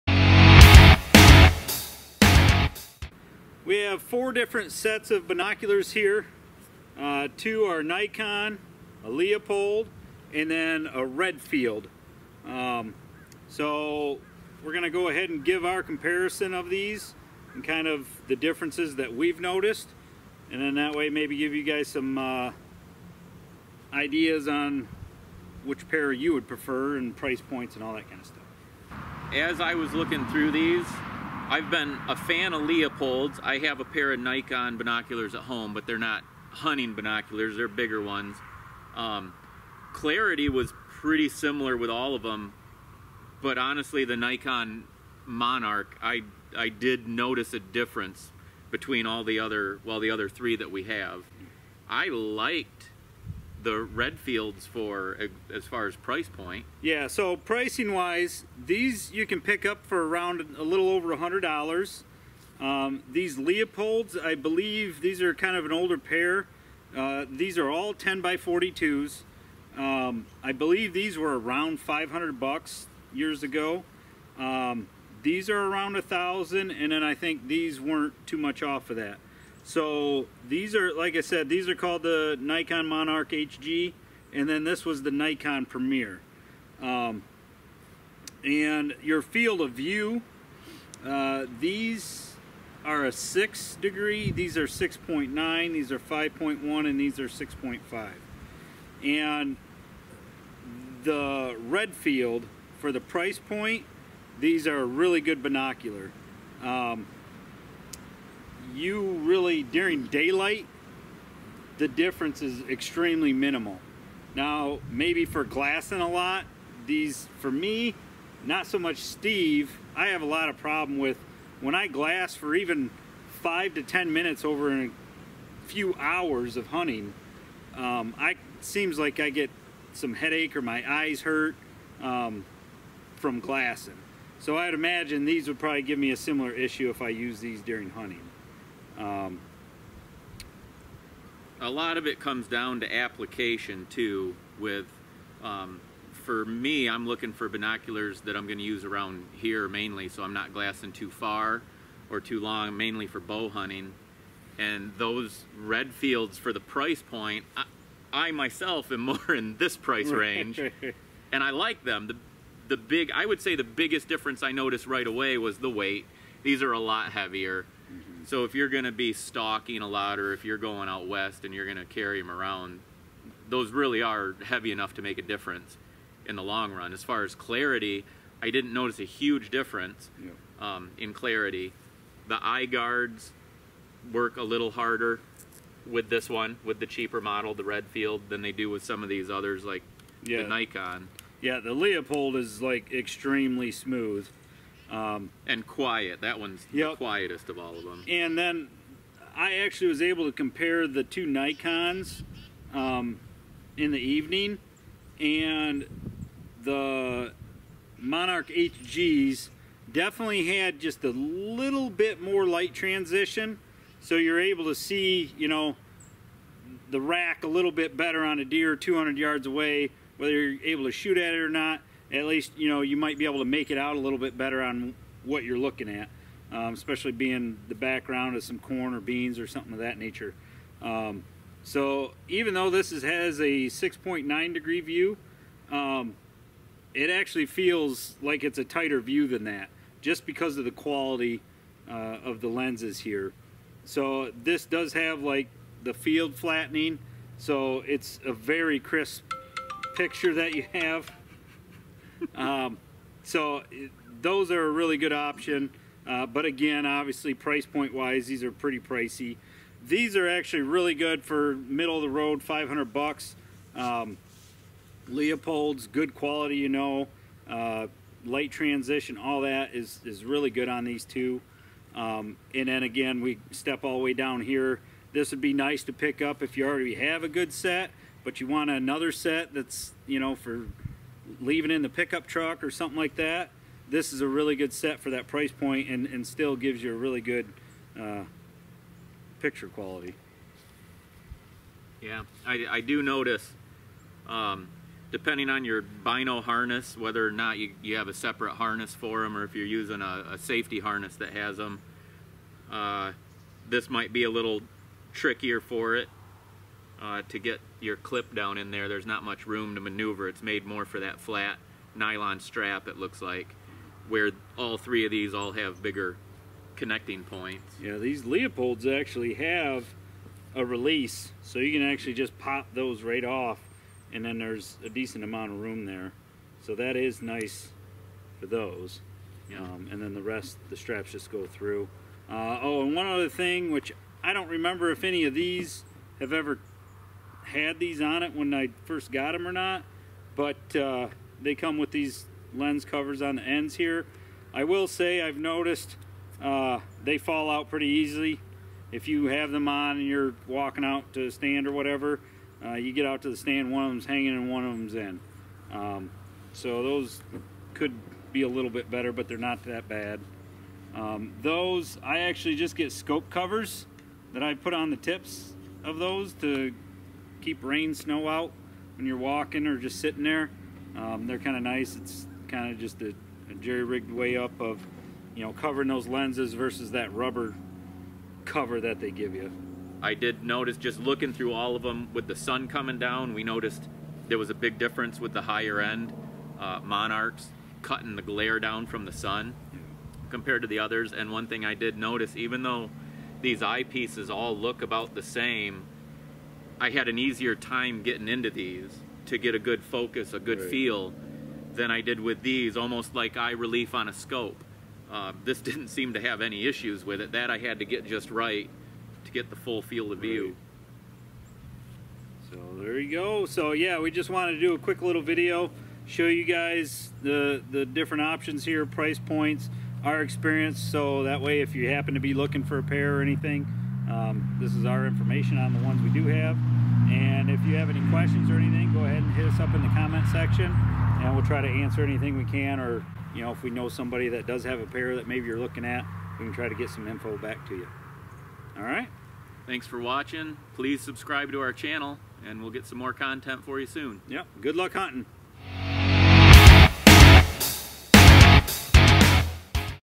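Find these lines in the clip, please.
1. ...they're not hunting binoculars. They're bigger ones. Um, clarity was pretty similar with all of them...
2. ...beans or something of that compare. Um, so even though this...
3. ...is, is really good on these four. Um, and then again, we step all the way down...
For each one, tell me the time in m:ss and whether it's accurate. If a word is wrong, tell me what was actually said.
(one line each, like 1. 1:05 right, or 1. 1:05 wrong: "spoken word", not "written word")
1. 0:35 right
2. 3:48 wrong: "nature", not "compare"
3. 4:29 wrong: "two", not "four".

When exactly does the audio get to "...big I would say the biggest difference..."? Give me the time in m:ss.
2:42.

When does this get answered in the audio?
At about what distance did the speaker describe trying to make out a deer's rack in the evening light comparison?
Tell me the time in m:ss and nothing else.
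3:38.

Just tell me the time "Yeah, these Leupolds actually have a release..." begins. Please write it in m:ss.
5:17.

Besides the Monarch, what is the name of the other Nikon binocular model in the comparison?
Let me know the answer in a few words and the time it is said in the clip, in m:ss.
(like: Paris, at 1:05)
Nikon Premier, at 1:25.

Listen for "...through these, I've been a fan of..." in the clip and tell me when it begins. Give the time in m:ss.
0:30.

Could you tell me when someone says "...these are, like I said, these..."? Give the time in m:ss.
1:20.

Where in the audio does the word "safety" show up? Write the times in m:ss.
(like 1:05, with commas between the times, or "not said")
5:00.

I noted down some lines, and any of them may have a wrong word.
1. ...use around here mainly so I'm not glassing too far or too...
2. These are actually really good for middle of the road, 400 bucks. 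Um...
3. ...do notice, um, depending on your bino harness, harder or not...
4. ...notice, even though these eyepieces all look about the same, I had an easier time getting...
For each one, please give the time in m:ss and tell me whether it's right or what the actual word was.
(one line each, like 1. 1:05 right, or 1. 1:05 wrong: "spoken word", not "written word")
1. 2:28 right
2. 4:19 wrong: "500", not "400"
3. 4:52 wrong: "whether", not "harder"
4. 6:31 right.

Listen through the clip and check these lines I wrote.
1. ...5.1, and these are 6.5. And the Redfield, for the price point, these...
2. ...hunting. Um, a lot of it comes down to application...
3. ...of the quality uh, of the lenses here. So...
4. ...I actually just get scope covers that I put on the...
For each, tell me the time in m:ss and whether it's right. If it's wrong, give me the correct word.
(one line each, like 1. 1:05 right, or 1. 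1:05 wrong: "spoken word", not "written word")
1. 1:35 right
2. 2:17 right
3. 4:00 right
4. 6:02 right.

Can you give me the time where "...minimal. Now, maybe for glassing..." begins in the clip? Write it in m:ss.
1:53.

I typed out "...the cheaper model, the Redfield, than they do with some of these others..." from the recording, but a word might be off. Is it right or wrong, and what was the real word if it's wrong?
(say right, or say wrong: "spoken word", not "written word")
right.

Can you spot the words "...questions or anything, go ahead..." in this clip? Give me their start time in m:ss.
7:08.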